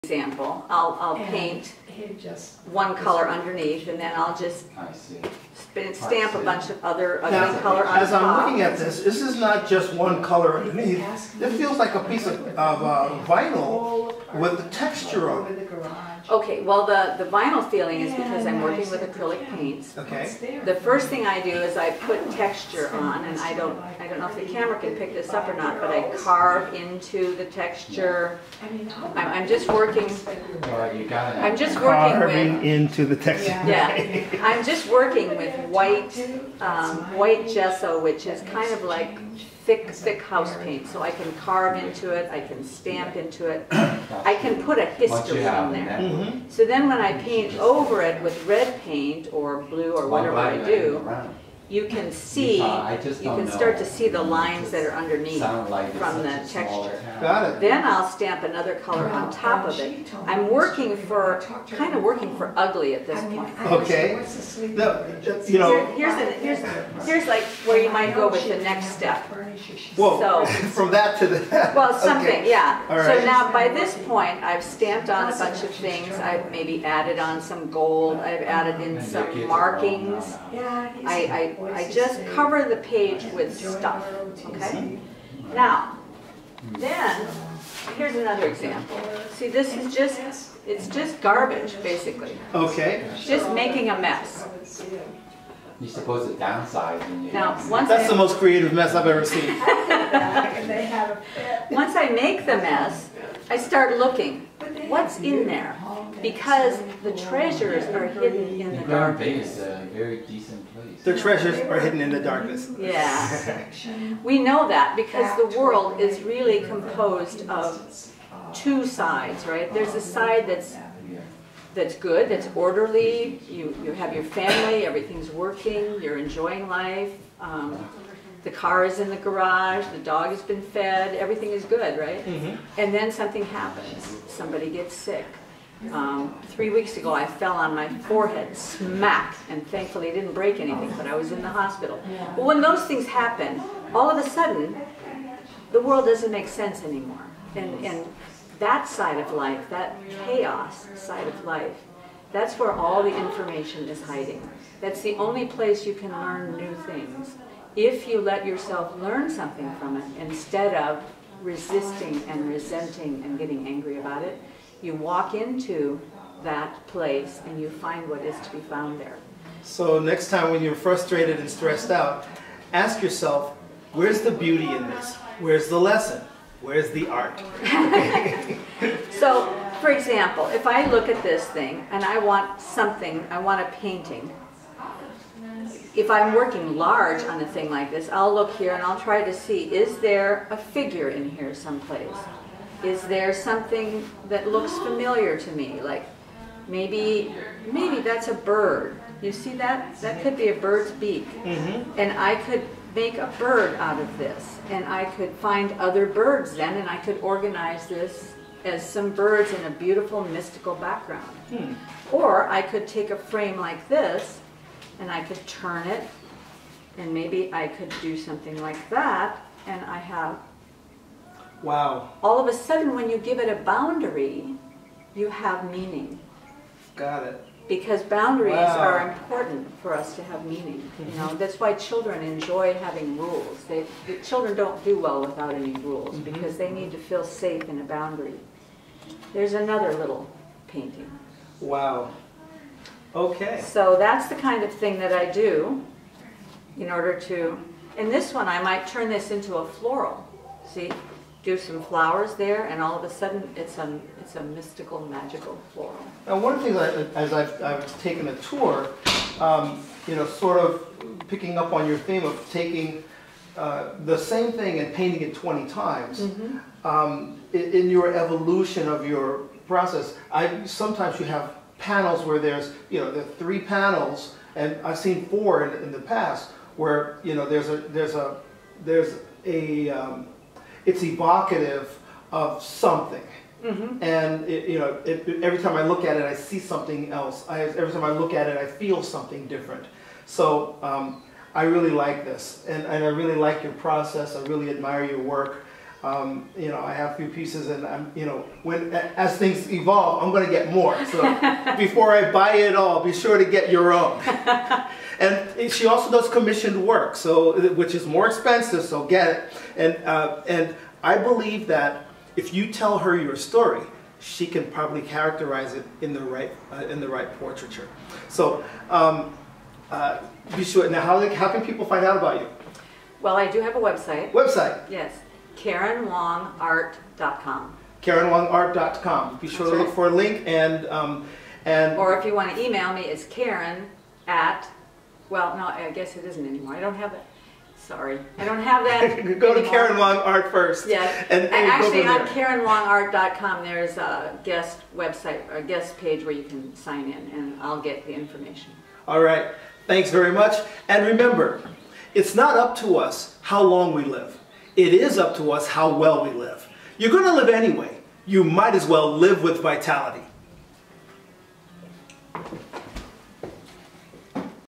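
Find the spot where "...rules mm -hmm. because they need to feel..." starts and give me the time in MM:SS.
03:55.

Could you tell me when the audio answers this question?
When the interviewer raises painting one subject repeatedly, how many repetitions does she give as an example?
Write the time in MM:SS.
04:25.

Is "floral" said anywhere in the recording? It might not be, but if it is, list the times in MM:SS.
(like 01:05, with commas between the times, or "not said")
04:09, 04:15.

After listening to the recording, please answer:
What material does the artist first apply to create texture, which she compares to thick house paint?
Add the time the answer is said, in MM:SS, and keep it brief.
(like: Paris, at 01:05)
White gesso, at 00:37.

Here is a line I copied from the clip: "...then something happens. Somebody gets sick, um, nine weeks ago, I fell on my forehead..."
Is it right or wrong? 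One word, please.
wrong.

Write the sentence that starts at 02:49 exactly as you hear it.
So next time when you're frustrated and stressed out, ask yourself, where's the beauty in this?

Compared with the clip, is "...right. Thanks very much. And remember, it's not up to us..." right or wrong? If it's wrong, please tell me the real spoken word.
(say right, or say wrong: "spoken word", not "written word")
right.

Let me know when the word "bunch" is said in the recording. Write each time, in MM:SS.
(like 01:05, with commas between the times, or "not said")
00:06, 01:15.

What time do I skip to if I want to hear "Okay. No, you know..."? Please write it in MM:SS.
01:03.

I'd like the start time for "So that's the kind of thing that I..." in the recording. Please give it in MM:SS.
04:03.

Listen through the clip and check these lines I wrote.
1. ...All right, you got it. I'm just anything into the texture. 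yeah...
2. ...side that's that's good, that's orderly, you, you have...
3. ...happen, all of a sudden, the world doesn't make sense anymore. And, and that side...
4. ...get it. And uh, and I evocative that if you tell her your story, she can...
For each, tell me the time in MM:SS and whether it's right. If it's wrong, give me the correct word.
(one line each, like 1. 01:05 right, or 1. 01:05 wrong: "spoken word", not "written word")
1. 00:30 wrong: "working", not "anything"
2. 02:00 right
3. 02:23 right
4. 05:09 wrong: "believe", not "evocative".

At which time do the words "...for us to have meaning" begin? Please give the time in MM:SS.
03:49.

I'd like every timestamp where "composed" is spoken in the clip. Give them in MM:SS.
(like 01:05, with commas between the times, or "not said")
01:56.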